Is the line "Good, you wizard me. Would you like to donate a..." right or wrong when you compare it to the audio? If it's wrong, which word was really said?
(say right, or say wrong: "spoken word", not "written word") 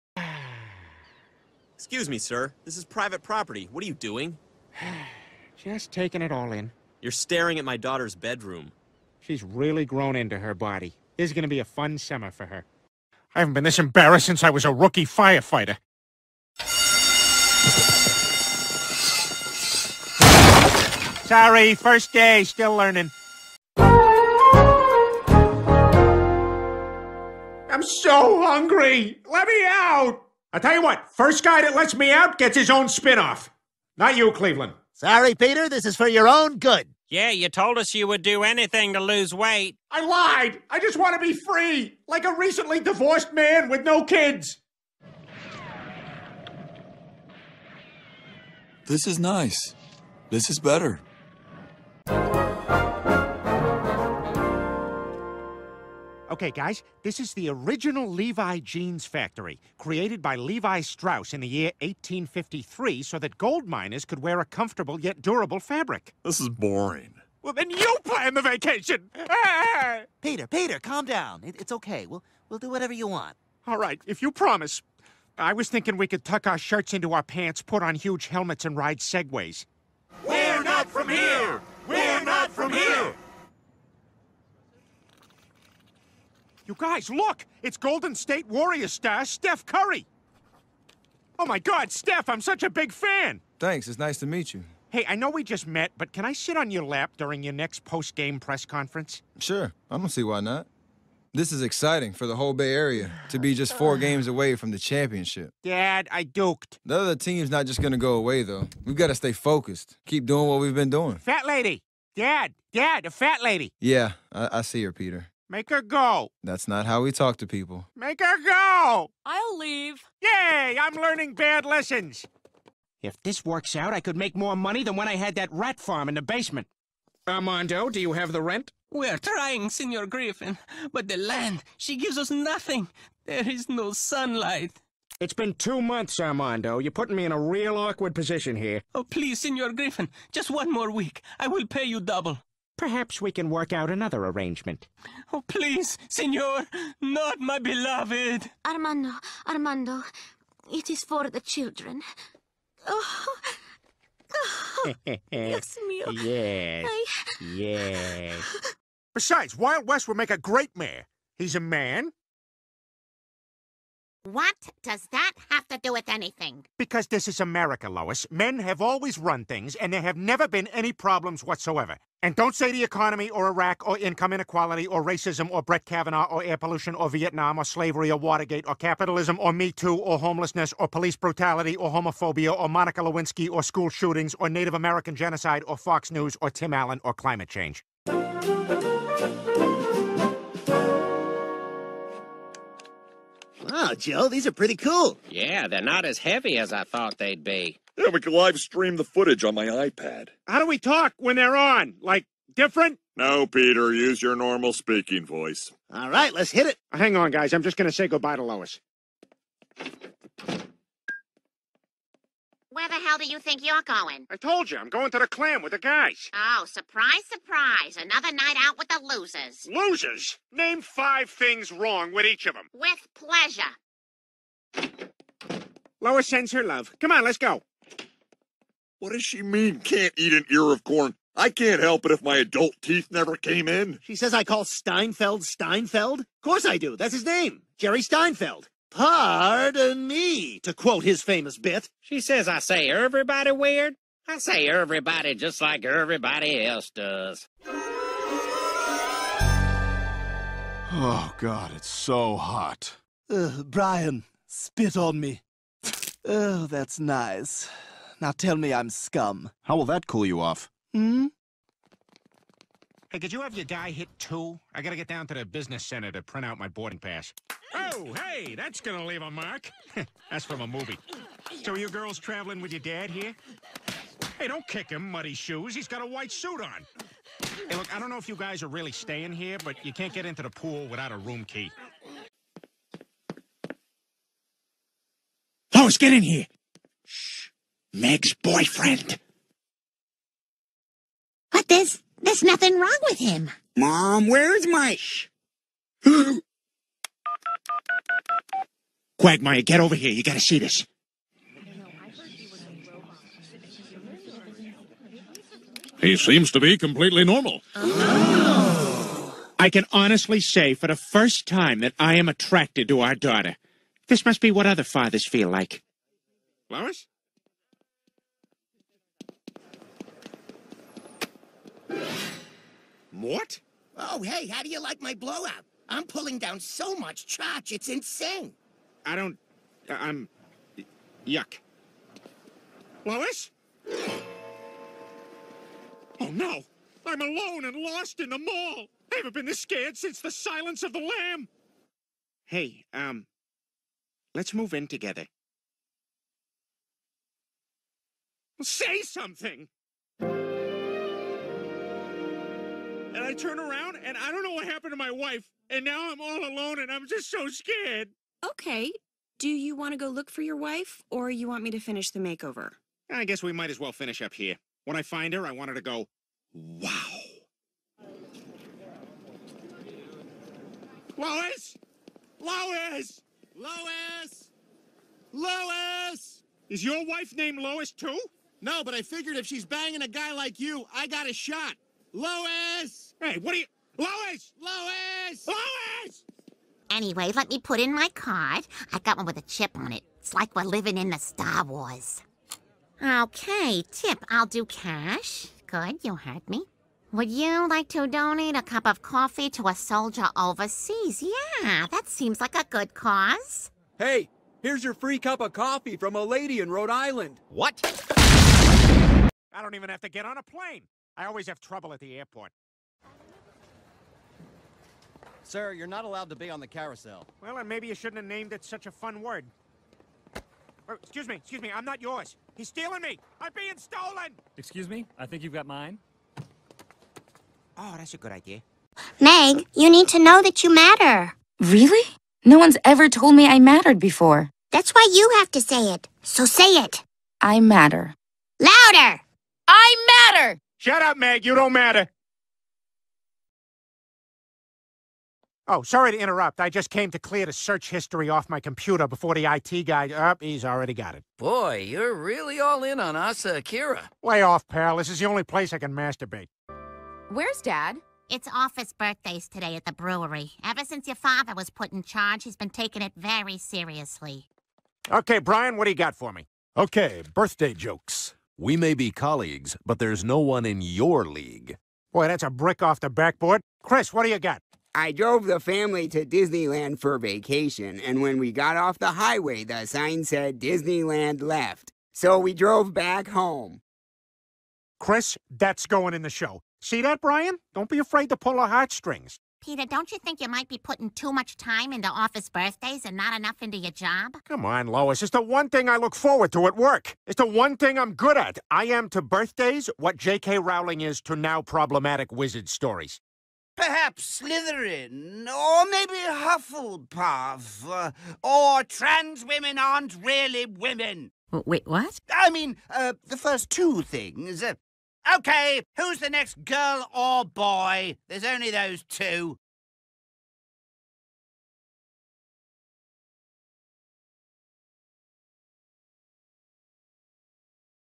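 wrong: "heard", not "wizard".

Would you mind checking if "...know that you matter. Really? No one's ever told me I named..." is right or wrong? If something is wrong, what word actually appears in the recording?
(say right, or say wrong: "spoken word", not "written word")
wrong: "mattered", not "named".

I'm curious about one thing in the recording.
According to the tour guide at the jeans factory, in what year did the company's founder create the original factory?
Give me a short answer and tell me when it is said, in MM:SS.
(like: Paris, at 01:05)
1853, at 01:01.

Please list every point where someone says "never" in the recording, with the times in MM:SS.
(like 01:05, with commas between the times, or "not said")
02:50, 03:53.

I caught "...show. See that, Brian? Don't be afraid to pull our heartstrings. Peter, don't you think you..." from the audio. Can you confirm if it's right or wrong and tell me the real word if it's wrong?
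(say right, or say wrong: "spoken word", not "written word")
right.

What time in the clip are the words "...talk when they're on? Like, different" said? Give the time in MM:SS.
03:20.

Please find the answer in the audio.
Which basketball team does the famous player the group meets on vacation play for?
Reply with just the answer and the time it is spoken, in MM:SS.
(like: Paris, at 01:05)
Golden State Warriors, at 01:27.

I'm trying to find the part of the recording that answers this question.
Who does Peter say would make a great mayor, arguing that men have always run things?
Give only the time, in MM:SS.
02:39.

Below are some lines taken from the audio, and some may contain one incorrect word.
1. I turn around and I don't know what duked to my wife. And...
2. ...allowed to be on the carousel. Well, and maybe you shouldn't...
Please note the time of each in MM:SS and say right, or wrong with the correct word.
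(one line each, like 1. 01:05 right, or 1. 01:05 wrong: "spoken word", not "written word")
1. 05:53 wrong: "happened", not "duked"
2. 06:56 right.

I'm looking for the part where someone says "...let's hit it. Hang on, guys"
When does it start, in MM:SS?
03:26.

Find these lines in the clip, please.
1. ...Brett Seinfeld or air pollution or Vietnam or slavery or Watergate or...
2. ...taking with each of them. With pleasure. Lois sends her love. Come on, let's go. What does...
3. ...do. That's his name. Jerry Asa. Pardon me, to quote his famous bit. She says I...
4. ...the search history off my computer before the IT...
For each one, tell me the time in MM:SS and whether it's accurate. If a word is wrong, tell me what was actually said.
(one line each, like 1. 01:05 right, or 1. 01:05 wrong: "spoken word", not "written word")
1. 02:55 wrong: "Kavanaugh", not "Seinfeld"
2. 03:41 wrong: "wrong", not "taking"
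3. 03:56 wrong: "Steinfeld", not "Asa"
4. 07:27 right.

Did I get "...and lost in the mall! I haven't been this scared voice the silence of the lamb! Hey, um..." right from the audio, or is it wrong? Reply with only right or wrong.
wrong.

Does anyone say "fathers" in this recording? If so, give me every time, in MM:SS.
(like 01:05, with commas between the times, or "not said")
05:14, 07:41.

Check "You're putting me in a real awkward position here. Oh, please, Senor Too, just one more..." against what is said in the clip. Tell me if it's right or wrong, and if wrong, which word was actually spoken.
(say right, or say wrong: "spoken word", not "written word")
wrong: "Griffin", not "Too".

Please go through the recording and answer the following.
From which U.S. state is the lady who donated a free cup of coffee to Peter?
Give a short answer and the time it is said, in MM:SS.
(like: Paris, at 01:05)
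Rhode Island, at 06:46.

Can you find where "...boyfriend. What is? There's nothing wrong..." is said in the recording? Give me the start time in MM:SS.
04:48.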